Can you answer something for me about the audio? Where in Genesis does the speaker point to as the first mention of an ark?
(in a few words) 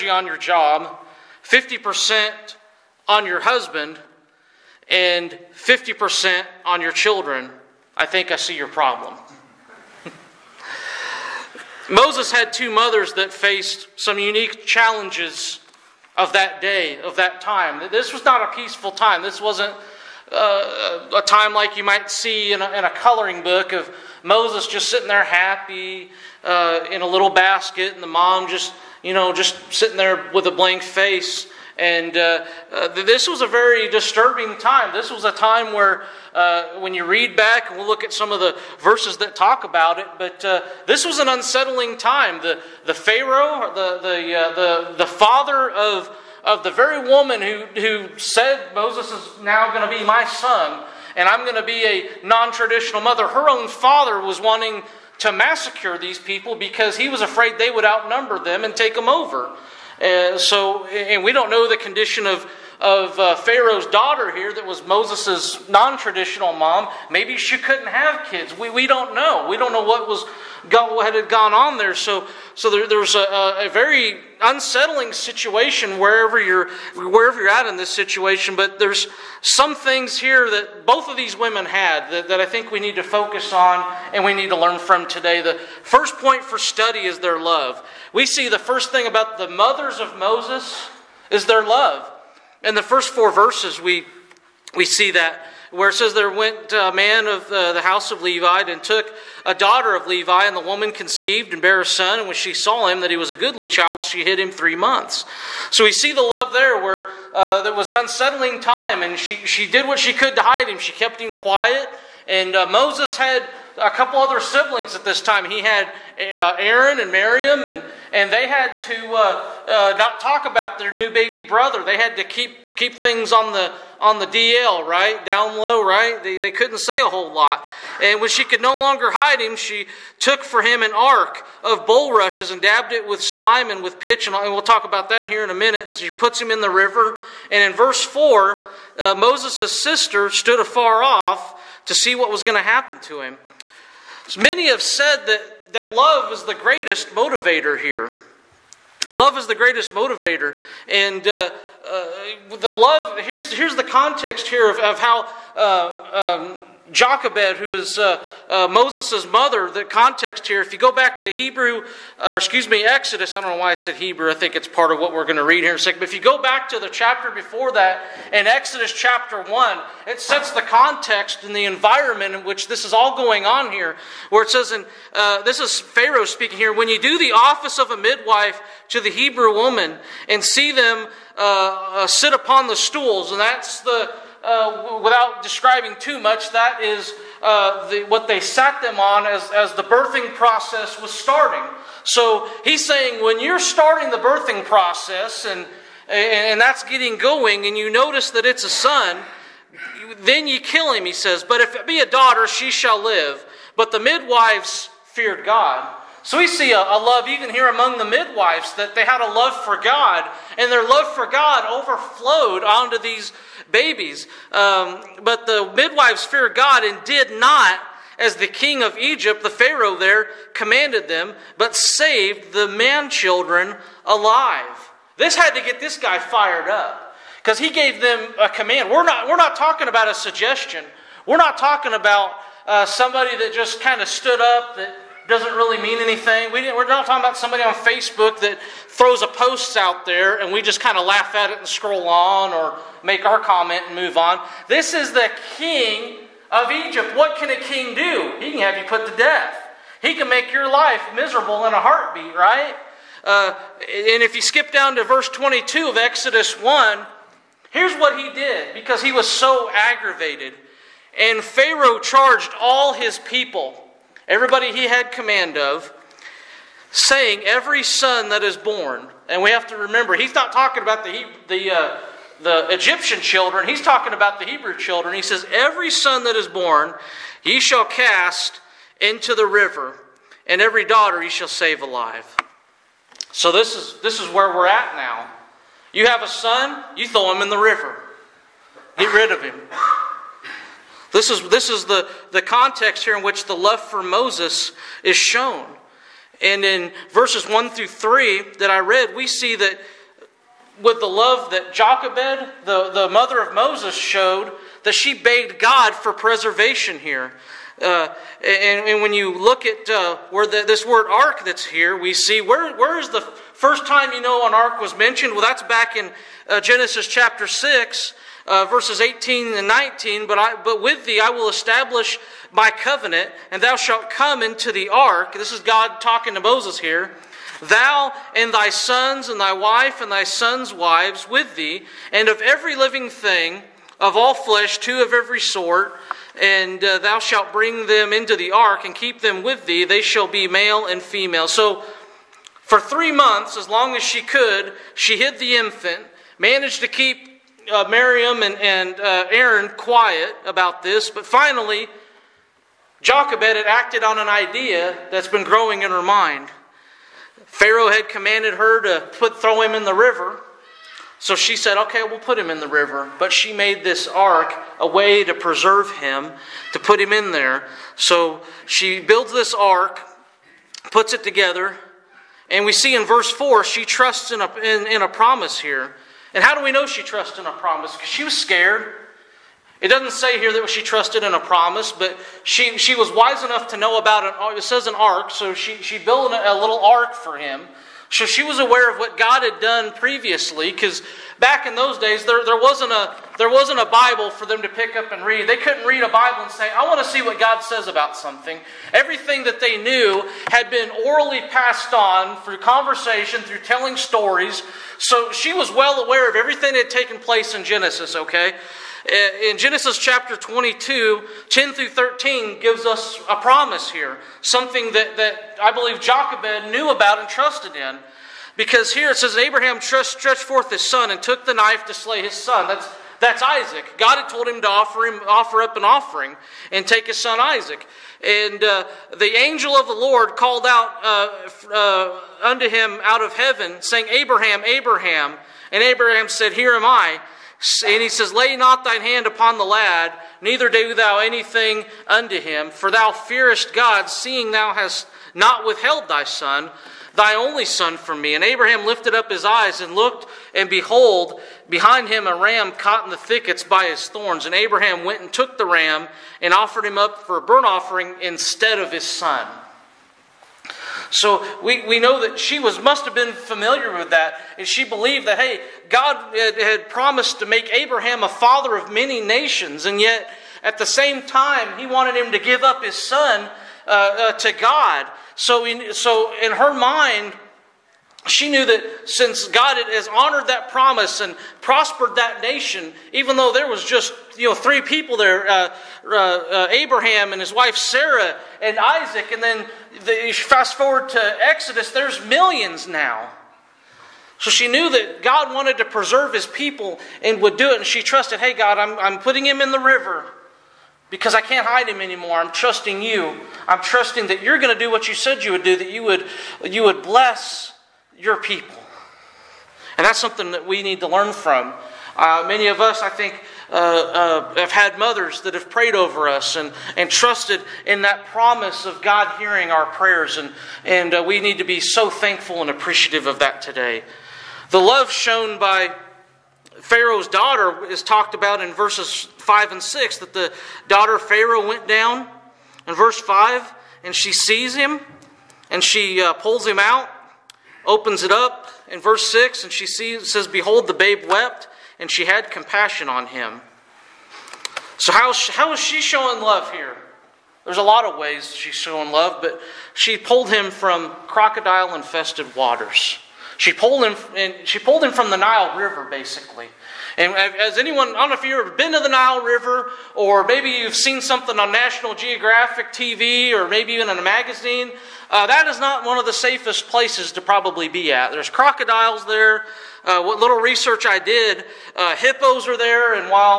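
Genesis chapter 6.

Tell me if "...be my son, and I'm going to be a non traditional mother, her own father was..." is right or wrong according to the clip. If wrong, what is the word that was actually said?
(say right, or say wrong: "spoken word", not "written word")
right.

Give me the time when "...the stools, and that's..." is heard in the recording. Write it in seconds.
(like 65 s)
182 s.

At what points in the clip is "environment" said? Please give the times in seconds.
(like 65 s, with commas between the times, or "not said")
171 s.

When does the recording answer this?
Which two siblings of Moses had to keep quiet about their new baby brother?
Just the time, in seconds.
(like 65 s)
116 s.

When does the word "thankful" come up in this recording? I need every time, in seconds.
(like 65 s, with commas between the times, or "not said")
522 s.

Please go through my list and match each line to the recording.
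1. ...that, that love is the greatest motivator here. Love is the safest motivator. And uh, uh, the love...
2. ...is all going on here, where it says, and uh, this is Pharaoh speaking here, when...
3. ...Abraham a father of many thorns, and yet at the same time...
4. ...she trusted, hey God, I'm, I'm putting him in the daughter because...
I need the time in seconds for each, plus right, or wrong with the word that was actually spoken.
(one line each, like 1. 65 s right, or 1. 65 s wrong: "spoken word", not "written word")
1. 145 s wrong: "greatest", not "safest"
2. 172 s right
3. 467 s wrong: "nations", not "thorns"
4. 497 s wrong: "river", not "daughter".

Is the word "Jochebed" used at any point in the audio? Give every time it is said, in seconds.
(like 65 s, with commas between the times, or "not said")
156 s, 301 s, 353 s, 416 s.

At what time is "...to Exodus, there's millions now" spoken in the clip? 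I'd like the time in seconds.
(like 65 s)
491 s.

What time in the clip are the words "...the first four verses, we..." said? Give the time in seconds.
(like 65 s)
92 s.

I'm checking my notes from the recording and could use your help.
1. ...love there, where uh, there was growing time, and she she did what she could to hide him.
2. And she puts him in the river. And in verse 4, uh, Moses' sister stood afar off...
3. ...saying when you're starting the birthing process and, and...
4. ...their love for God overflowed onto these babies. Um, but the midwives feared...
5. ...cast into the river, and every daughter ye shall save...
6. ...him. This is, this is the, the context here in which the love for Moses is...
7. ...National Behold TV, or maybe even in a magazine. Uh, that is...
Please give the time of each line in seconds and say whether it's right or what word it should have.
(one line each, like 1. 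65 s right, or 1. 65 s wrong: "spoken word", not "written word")
1. 106 s wrong: "unsettling", not "growing"
2. 135 s right
3. 192 s right
4. 210 s right
5. 277 s right
6. 289 s right
7. 561 s wrong: "Geographic", not "Behold".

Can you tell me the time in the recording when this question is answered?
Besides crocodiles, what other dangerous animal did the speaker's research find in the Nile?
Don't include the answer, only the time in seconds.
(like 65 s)
572 s.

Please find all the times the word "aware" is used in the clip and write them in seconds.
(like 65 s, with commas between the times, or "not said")
388 s, 406 s.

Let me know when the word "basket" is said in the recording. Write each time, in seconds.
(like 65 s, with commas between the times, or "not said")
27 s.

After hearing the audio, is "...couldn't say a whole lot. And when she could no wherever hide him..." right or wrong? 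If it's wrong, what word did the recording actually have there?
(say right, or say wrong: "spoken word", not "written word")
wrong: "longer", not "wherever".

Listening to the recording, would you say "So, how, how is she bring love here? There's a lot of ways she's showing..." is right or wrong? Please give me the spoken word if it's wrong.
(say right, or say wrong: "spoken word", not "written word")
wrong: "showing", not "bring".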